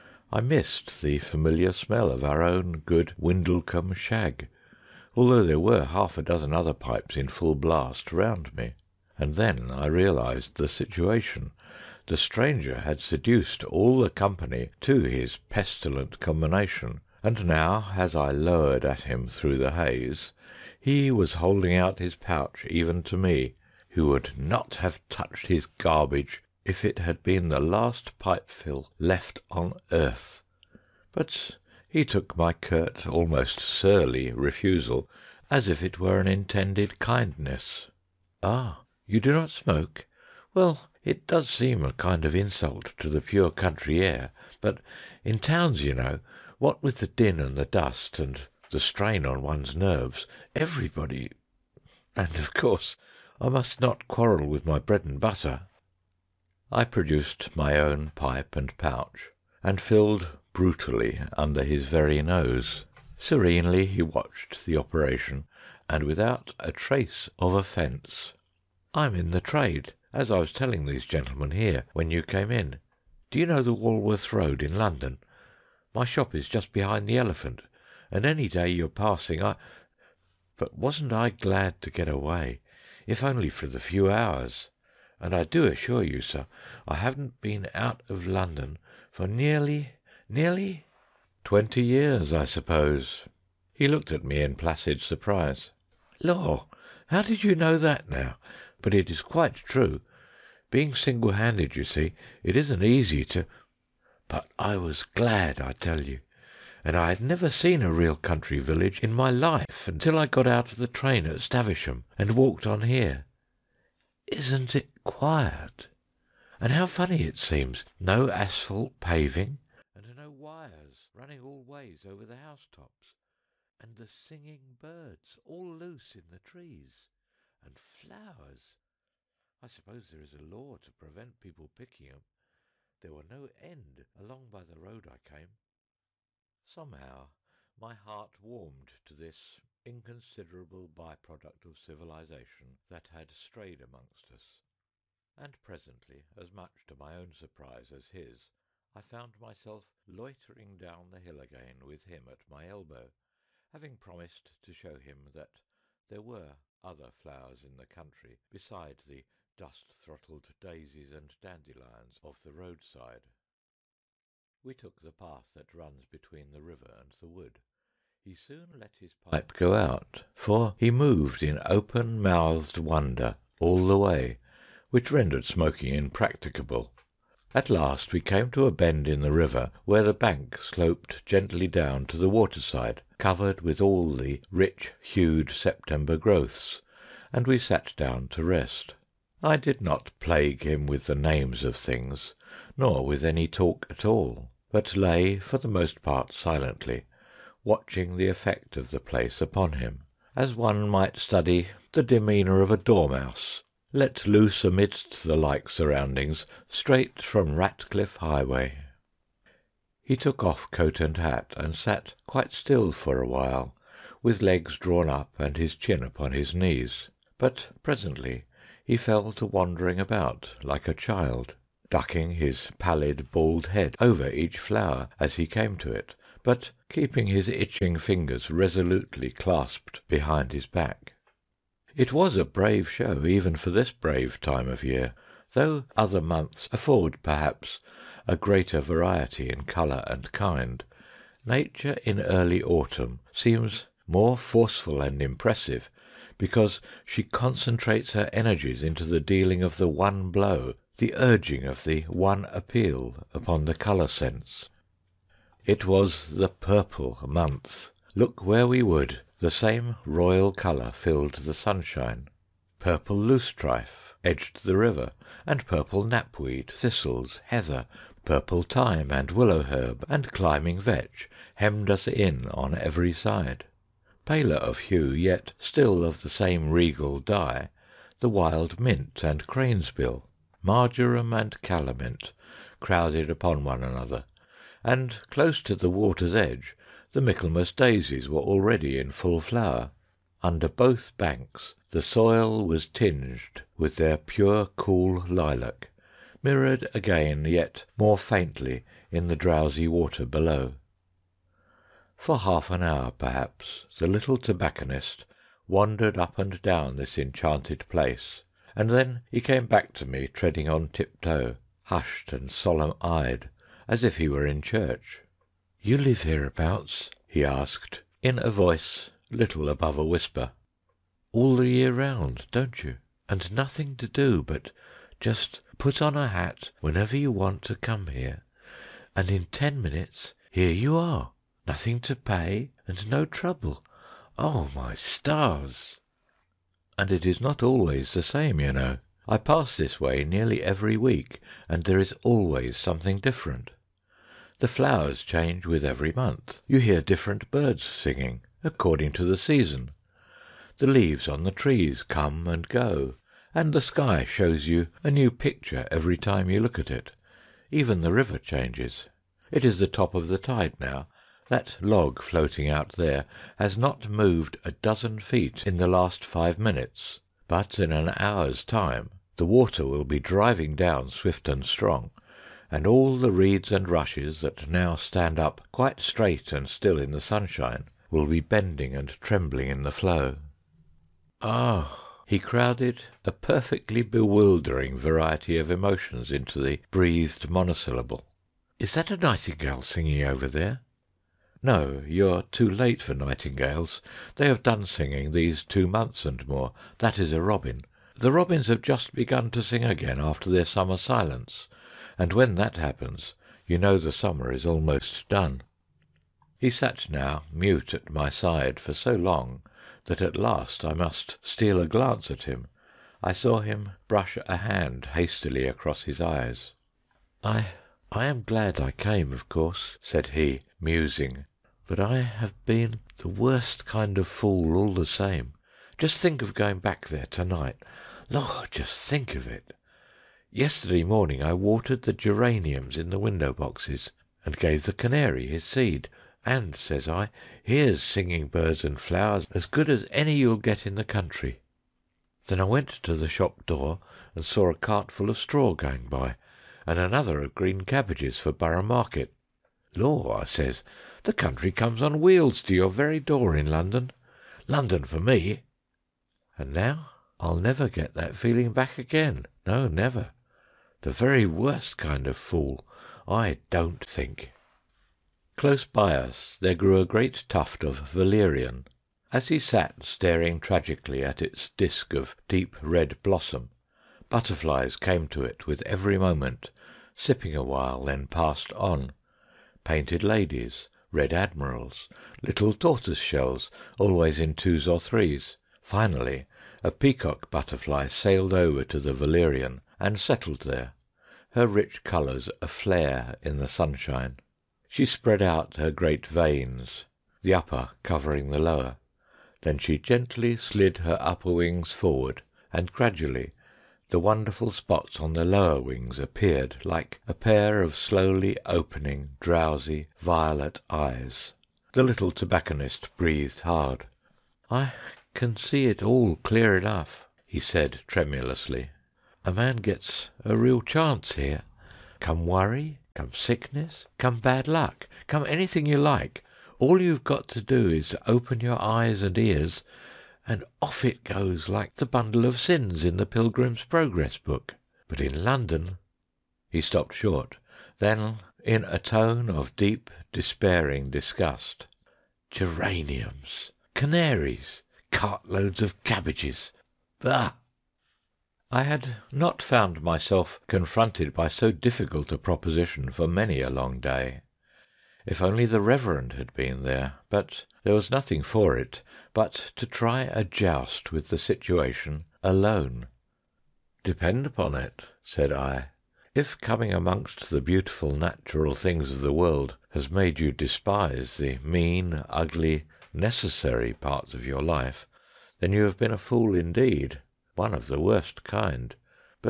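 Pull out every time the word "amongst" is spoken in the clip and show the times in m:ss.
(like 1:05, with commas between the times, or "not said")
2:23, 9:26.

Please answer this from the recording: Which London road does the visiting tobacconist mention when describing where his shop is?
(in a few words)
Walworth Road.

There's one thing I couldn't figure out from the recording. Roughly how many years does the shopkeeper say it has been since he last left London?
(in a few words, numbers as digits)
20.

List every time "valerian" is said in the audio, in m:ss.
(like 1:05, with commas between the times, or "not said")
7:48, 8:09.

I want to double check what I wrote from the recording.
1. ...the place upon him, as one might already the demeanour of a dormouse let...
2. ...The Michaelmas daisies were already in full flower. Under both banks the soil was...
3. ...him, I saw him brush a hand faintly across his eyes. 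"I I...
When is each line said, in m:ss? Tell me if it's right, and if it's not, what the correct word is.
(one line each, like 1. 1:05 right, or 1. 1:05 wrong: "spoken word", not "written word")
1. 3:18 wrong: "study", not "already"
2. 4:47 right
3. 6:52 wrong: "hastily", not "faintly".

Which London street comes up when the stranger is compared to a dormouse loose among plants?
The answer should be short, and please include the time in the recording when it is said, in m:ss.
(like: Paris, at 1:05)
Ratcliffe Highway, at 3:27.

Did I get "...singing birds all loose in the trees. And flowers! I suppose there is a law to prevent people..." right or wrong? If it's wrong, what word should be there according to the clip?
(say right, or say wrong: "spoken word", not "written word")
right.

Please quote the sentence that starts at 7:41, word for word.
The very worst kind of fool, I don't think.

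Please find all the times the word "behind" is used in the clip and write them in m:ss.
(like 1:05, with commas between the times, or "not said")
1:16, 3:50.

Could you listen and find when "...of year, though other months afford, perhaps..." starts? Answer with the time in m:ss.
3:54.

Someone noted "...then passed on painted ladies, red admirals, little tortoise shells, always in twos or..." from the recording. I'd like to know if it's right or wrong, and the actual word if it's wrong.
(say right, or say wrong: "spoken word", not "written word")
right.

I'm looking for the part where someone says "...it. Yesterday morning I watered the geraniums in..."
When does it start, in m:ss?
7:09.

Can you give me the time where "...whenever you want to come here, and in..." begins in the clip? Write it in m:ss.
5:26.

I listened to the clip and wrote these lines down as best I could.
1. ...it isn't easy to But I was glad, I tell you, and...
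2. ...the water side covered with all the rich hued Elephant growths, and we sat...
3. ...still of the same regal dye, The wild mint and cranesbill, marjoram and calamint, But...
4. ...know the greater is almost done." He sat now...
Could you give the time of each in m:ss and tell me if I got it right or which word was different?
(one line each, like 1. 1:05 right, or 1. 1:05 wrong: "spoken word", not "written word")
1. 1:42 right
2. 3:02 wrong: "September", not "Elephant"
3. 4:35 wrong: "Crowded", not "But"
4. 6:43 wrong: "summer", not "greater".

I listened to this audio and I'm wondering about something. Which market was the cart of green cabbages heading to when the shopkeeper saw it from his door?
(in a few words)
Borough Market.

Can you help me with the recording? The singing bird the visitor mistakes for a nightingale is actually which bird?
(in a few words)
Robin.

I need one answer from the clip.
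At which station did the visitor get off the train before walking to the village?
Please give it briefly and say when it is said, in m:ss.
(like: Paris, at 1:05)
Stavisham, at 1:51.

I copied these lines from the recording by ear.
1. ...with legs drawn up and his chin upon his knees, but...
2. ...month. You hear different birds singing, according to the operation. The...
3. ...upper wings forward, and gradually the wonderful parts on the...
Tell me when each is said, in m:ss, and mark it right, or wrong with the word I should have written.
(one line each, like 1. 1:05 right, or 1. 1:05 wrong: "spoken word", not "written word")
1. 3:34 right
2. 5:46 wrong: "season", not "operation"
3. 8:21 wrong: "spots", not "parts".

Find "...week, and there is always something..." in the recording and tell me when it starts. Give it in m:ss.
5:40.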